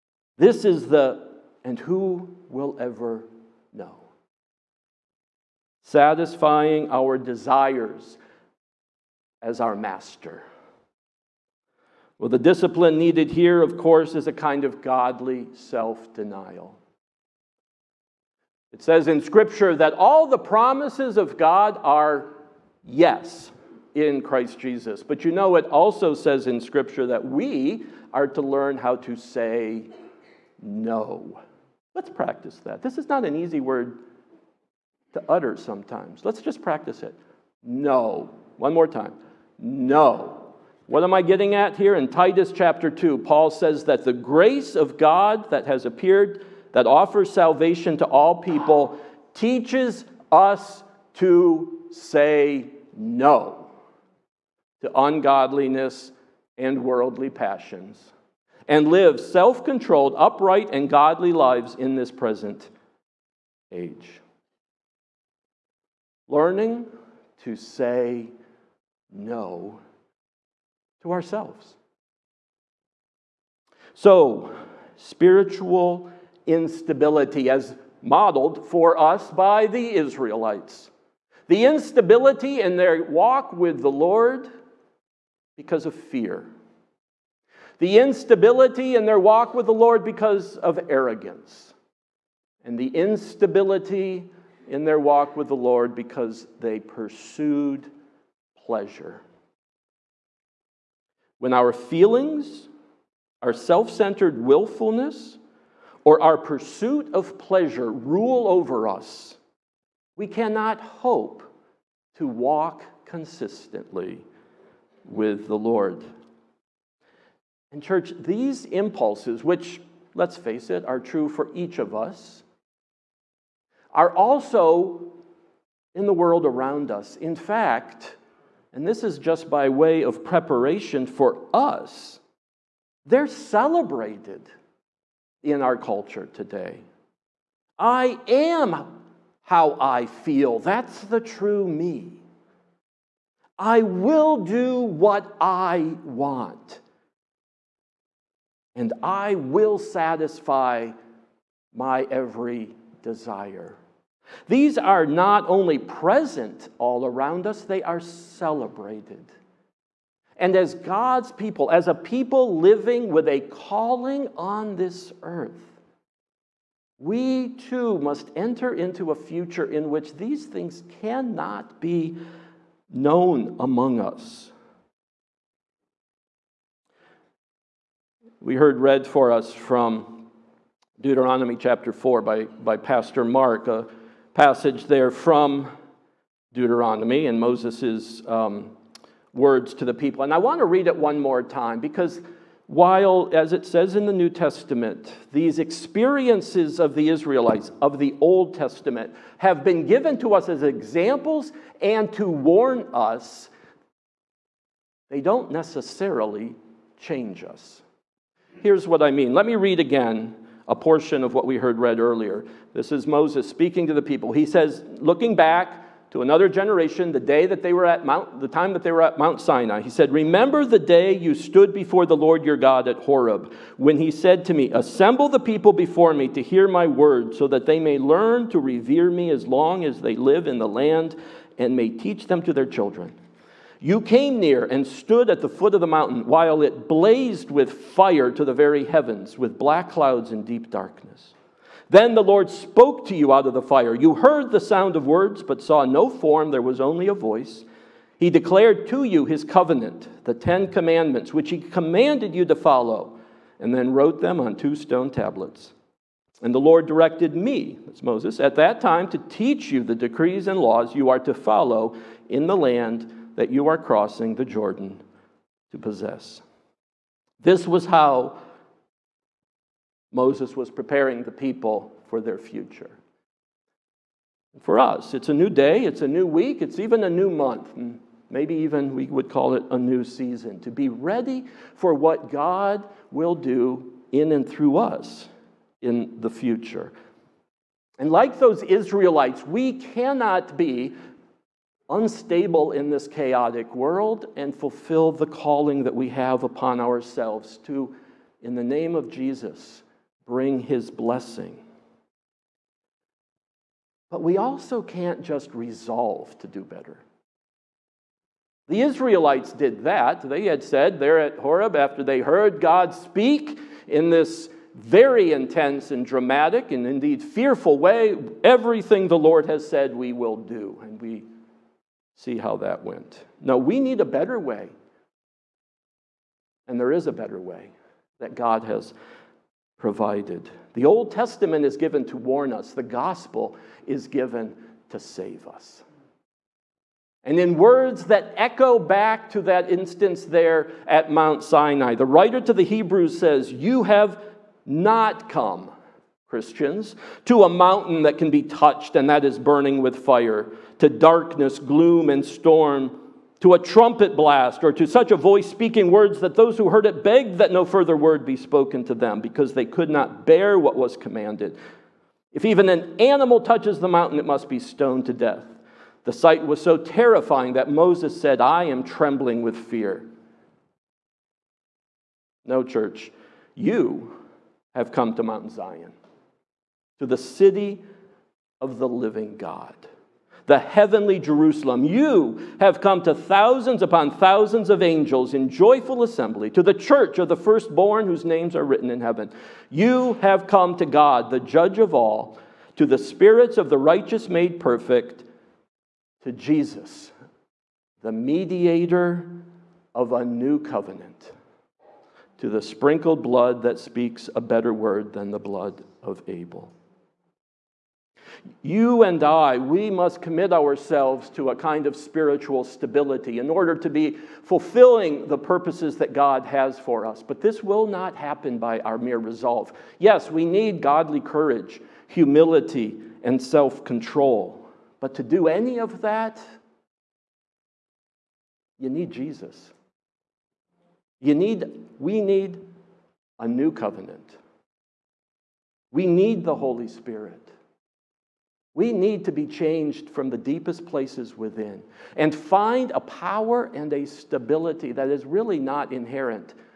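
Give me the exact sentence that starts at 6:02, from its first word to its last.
If even an animal touches the mountain, it must be stoned to death.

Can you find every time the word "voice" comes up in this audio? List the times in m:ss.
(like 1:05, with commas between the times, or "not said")
4:07, 5:55.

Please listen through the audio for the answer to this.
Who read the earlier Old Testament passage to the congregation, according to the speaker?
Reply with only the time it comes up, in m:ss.
3:02.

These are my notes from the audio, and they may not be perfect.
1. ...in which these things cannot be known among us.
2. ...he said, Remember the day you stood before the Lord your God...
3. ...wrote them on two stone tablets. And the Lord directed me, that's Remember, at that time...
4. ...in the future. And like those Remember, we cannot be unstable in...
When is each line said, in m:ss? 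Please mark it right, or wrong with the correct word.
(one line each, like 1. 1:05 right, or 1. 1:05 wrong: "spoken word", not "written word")
1. 2:49 right
2. 3:39 right
3. 4:13 wrong: "Moses", not "Remember"
4. 4:45 wrong: "Israelites", not "Remember".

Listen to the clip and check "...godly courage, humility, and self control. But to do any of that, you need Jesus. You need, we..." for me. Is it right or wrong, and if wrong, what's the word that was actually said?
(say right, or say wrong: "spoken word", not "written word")
right.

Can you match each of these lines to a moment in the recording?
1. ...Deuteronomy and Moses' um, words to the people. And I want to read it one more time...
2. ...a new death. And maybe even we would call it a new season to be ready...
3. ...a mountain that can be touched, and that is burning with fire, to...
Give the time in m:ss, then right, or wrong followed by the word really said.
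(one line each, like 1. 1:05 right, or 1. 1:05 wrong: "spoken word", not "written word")
1. 3:06 right
2. 4:37 wrong: "month", not "death"
3. 5:47 right.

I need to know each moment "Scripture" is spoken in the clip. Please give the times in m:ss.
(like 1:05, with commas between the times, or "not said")
0:19, 0:26.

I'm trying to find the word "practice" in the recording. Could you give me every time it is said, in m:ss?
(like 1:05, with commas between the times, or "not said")
0:32, 0:36.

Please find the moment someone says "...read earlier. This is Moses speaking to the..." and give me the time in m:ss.
3:31.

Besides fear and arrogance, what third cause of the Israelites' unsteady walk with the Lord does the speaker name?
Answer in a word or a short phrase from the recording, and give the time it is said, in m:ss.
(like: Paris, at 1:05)
pursued pleasure, at 1:36.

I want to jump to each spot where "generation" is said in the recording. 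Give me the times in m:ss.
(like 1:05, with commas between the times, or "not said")
3:36.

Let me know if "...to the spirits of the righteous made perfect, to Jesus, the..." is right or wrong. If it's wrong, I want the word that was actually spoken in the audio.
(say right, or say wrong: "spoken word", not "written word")
right.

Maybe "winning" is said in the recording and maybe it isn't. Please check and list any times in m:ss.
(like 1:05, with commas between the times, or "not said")
not said.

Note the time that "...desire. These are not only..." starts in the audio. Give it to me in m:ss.
2:33.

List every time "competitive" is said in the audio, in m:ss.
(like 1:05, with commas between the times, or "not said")
not said.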